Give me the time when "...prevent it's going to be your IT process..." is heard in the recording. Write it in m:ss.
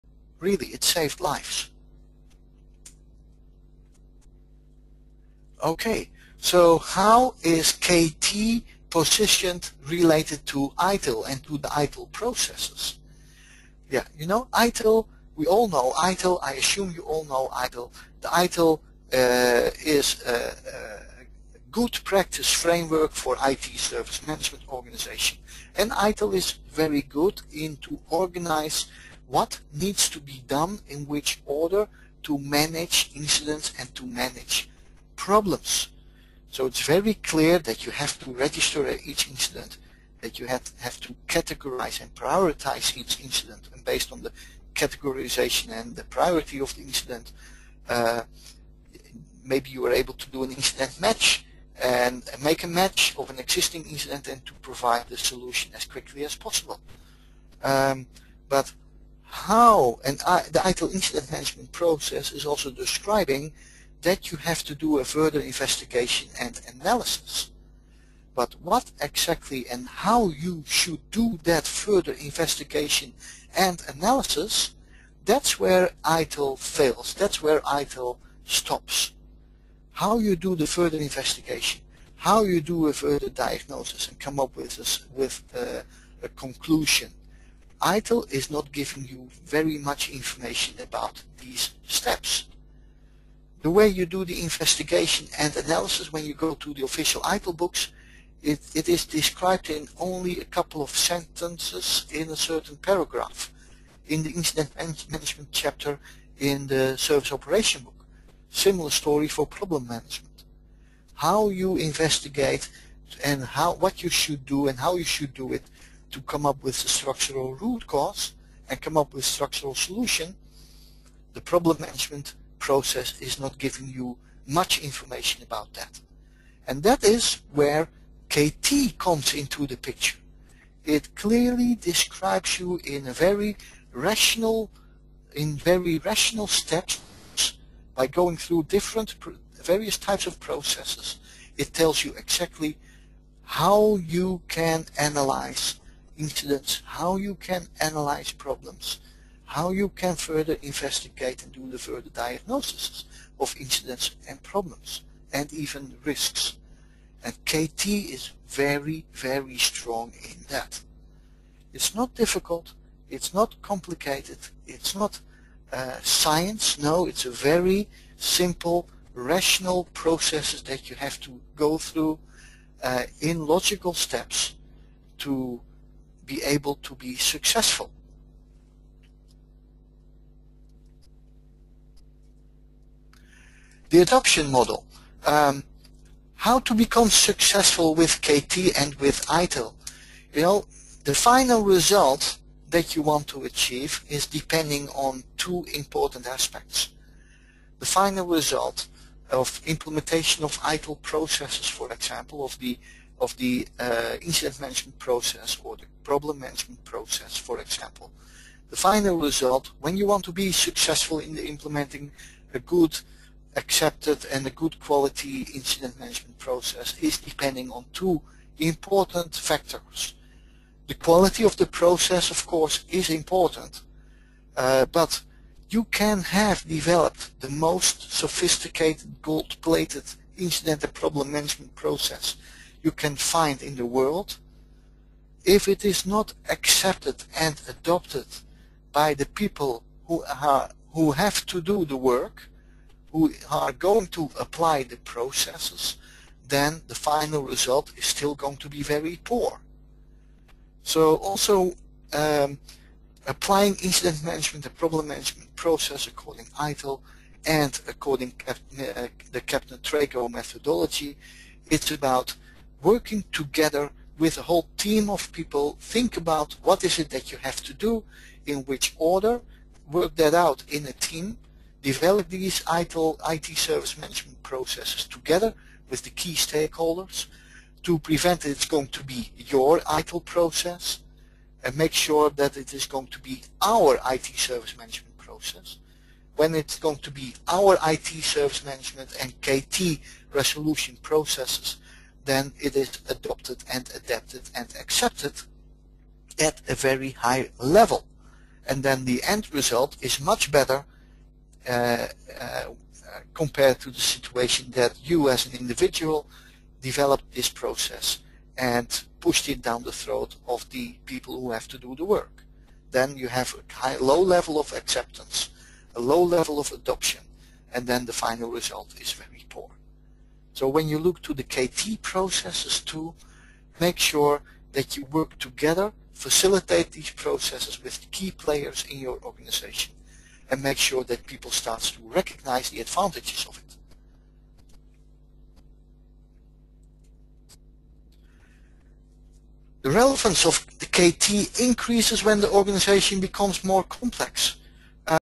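4:37.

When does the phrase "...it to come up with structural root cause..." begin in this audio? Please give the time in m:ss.
1:55.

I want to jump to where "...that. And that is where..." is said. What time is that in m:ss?
2:05.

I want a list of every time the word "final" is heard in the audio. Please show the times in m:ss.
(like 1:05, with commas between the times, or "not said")
3:11, 3:17, 3:28, 4:06, 5:18.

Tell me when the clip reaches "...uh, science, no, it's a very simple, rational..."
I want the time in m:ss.
2:45.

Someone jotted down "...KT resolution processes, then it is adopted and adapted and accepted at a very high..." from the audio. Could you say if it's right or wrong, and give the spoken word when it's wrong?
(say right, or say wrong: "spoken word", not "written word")
right.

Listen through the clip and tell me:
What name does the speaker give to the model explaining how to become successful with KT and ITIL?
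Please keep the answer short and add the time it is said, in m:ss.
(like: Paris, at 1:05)
The adoption model, at 3:03.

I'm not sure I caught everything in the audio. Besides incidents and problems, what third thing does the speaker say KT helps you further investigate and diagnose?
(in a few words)
risks.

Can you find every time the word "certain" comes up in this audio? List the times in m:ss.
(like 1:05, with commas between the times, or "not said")
1:42.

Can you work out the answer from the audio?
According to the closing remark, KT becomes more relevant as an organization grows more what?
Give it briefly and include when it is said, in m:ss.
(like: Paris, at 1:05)
complex, at 5:43.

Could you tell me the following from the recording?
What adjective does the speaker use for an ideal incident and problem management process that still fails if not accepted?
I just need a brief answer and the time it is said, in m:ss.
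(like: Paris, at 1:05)
gold-plated, at 3:49.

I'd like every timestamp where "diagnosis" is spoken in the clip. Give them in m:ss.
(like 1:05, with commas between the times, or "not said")
1:23, 2:32.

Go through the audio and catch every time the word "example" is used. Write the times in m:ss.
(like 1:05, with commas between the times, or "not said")
3:21, 3:27.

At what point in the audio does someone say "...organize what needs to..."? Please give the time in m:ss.
0:28.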